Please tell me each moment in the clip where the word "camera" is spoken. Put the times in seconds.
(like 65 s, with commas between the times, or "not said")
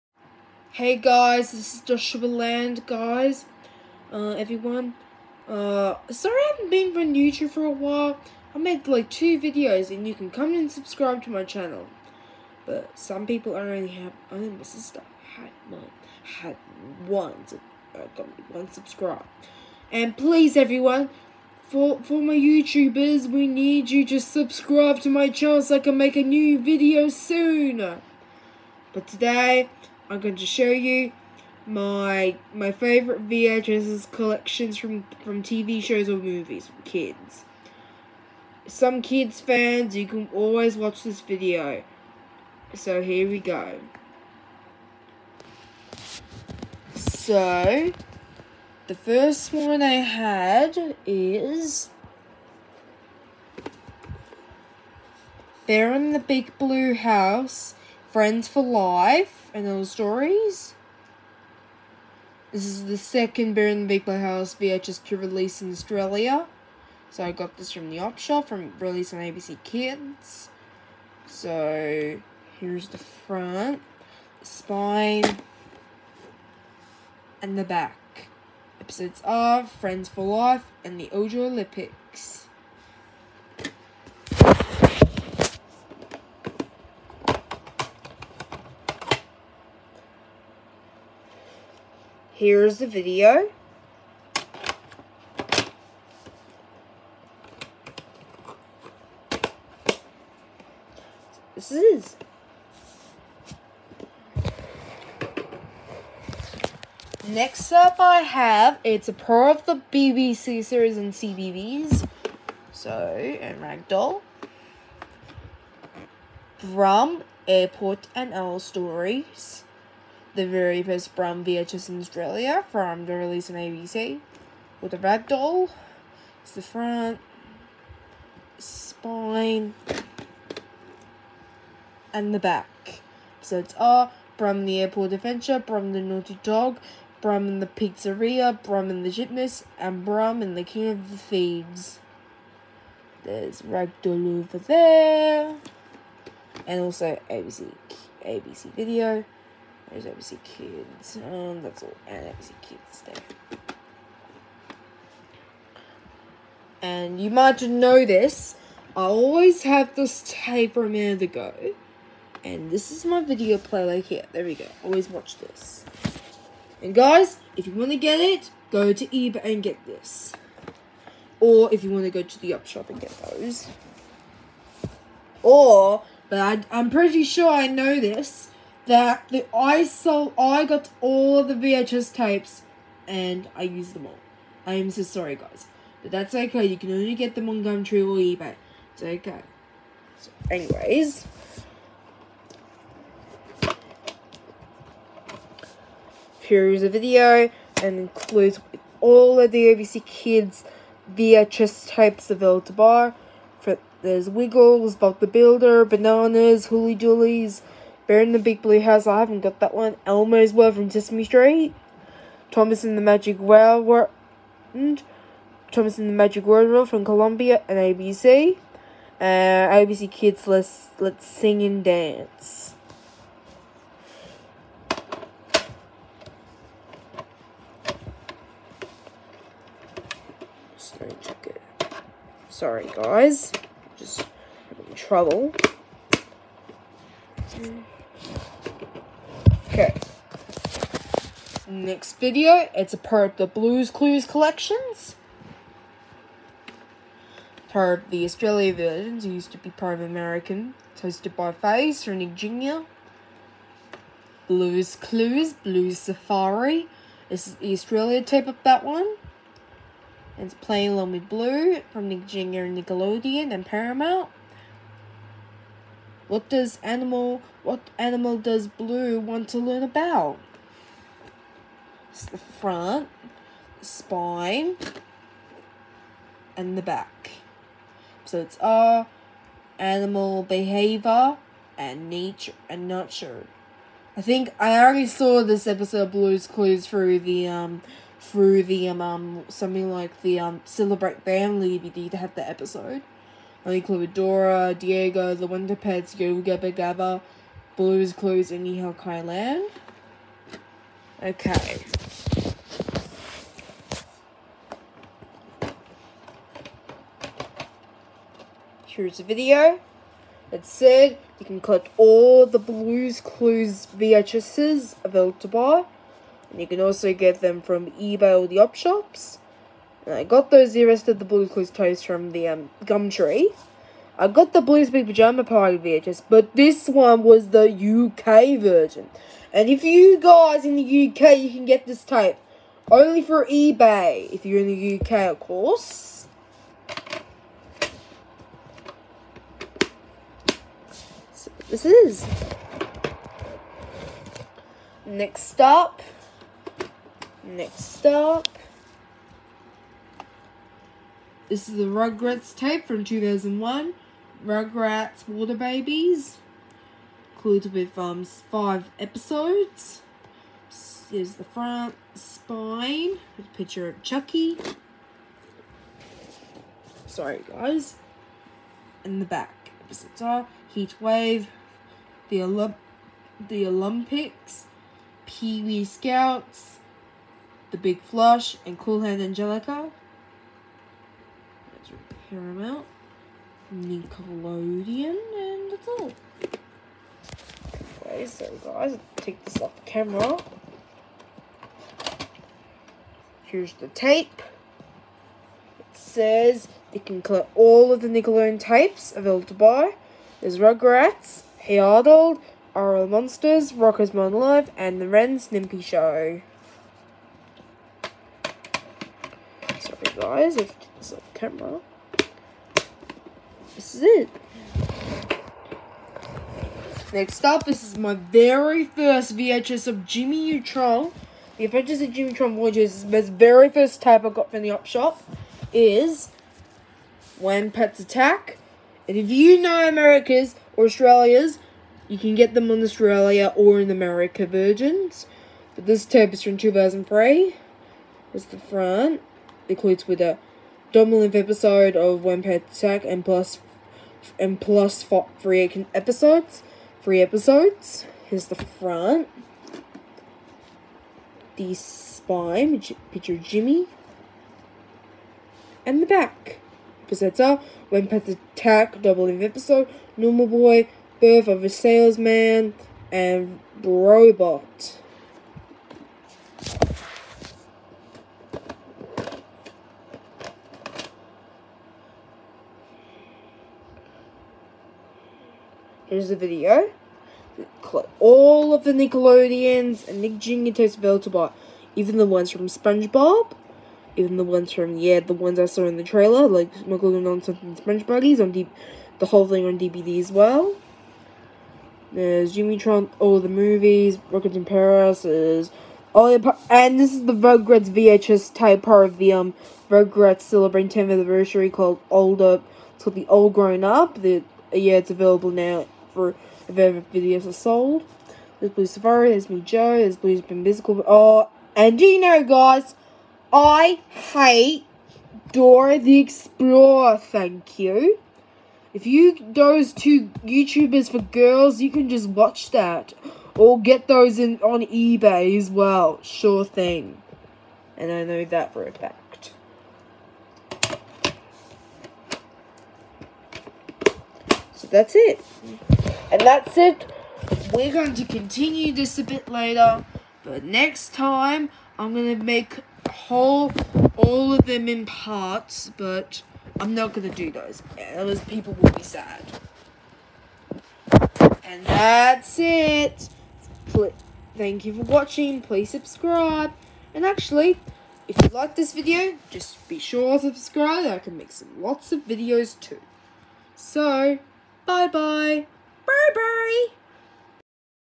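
389 s, 411 s.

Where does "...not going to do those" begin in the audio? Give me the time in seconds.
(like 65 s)
546 s.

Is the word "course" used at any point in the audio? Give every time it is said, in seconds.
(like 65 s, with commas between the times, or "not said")
335 s.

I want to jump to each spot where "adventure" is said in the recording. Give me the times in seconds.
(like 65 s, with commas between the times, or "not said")
135 s, 421 s.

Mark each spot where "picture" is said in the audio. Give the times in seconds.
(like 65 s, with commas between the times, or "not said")
363 s, 453 s.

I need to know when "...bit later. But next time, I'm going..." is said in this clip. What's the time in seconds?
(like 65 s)
539 s.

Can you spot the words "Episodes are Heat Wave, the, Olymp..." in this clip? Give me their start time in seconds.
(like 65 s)
369 s.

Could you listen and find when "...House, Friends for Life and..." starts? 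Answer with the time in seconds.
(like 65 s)
56 s.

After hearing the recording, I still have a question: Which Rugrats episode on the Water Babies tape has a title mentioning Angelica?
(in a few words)
Cool Hand Angelica.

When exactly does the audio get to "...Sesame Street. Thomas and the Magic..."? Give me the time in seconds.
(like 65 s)
210 s.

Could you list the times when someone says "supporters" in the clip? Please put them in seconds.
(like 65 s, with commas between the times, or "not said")
not said.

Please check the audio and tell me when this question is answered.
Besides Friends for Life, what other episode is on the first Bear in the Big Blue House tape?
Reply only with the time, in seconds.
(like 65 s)
80 s.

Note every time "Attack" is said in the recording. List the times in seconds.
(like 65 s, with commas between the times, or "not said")
427 s, 442 s, 458 s.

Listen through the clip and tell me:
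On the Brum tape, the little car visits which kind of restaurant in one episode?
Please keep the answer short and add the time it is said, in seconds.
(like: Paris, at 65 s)
Pizzeria, at 137 s.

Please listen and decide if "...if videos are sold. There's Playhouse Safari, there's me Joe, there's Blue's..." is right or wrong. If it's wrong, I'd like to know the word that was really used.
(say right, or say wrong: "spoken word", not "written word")
wrong: "Blue", not "Playhouse".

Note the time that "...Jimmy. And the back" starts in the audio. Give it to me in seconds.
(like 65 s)
453 s.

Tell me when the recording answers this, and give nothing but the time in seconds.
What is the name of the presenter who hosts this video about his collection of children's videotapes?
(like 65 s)
1 s.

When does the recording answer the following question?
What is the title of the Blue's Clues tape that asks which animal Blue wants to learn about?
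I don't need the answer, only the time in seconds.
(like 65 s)
255 s.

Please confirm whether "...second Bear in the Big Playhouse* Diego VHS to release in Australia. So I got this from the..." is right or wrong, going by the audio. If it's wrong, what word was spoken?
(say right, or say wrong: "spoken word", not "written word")
wrong: "House", not "Diego".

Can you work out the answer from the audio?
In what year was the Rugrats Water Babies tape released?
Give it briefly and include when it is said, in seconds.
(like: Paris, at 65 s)
2001, at 353 s.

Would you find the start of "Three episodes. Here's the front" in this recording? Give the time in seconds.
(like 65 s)
447 s.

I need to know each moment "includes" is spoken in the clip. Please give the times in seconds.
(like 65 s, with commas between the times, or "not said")
197 s, 357 s, 439 s.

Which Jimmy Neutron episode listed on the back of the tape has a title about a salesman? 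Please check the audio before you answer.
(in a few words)
Birth of a Salesman.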